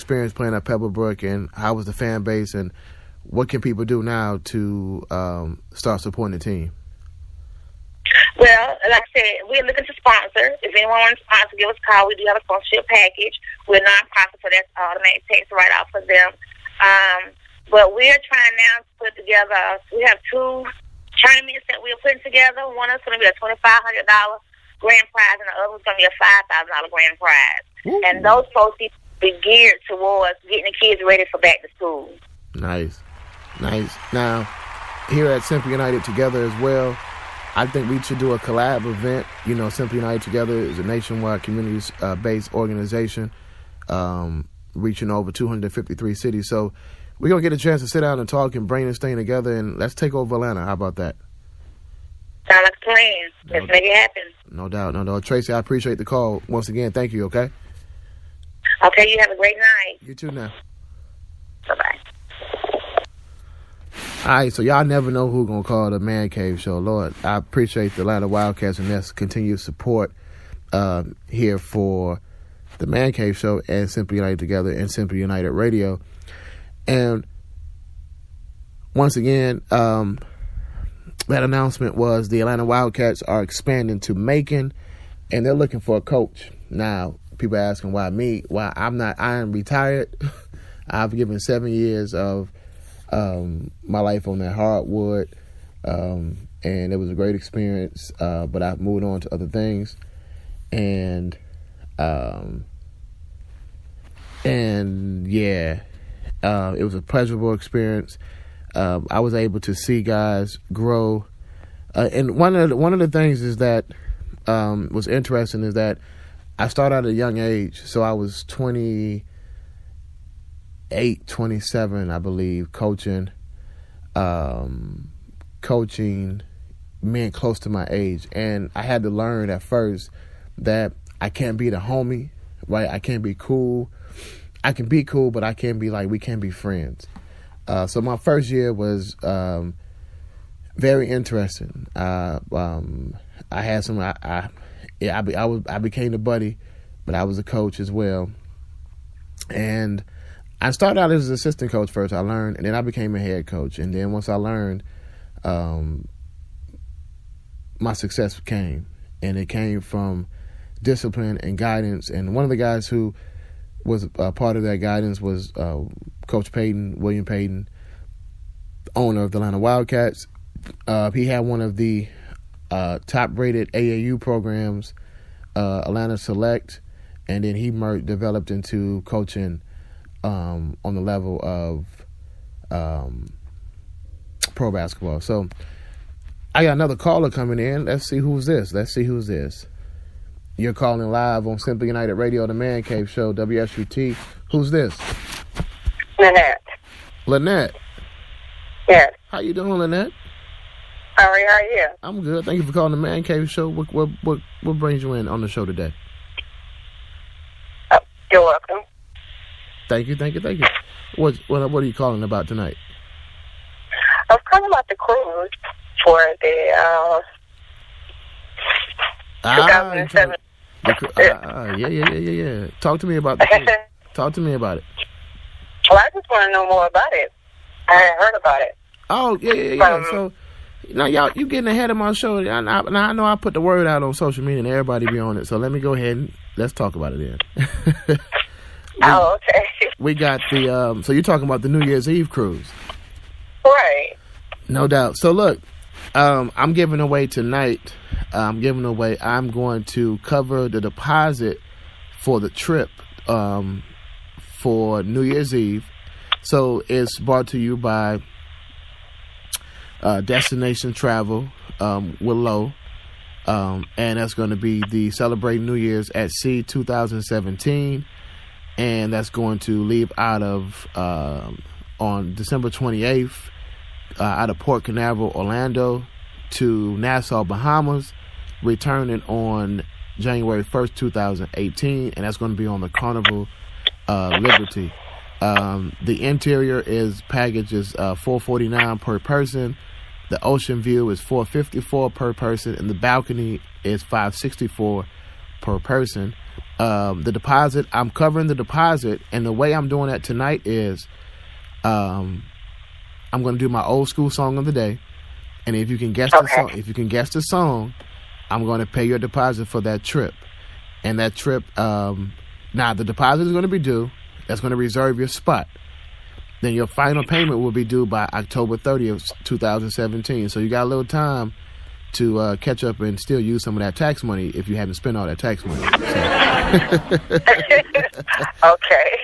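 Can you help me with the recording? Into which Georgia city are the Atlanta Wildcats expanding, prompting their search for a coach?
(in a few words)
Macon.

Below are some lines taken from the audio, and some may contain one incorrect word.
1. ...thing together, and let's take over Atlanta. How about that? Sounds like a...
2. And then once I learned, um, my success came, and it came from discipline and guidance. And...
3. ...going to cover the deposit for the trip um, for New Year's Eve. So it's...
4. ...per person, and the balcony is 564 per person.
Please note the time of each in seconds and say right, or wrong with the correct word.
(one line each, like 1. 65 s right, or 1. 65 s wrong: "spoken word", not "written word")
1. 48 s right
2. 153 s right
3. 249 s right
4. 292 s right.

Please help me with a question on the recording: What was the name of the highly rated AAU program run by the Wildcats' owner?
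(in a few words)
Atlanta Select.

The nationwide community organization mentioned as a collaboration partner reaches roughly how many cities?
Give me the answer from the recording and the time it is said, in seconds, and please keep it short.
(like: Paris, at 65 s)
253, at 45 s.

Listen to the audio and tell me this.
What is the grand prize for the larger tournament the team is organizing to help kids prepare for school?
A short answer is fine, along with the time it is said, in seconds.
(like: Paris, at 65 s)
$5,000, at 26 s.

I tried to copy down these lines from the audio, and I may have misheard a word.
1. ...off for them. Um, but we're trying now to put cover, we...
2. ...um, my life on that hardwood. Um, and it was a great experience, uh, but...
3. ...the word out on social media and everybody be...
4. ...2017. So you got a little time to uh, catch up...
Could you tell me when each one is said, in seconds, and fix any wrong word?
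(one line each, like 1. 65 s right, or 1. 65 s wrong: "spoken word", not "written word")
1. 15 s wrong: "together", not "cover"
2. 93 s right
3. 233 s right
4. 319 s right.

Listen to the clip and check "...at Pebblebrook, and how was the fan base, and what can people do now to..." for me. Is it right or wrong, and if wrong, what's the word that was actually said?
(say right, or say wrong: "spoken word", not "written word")
right.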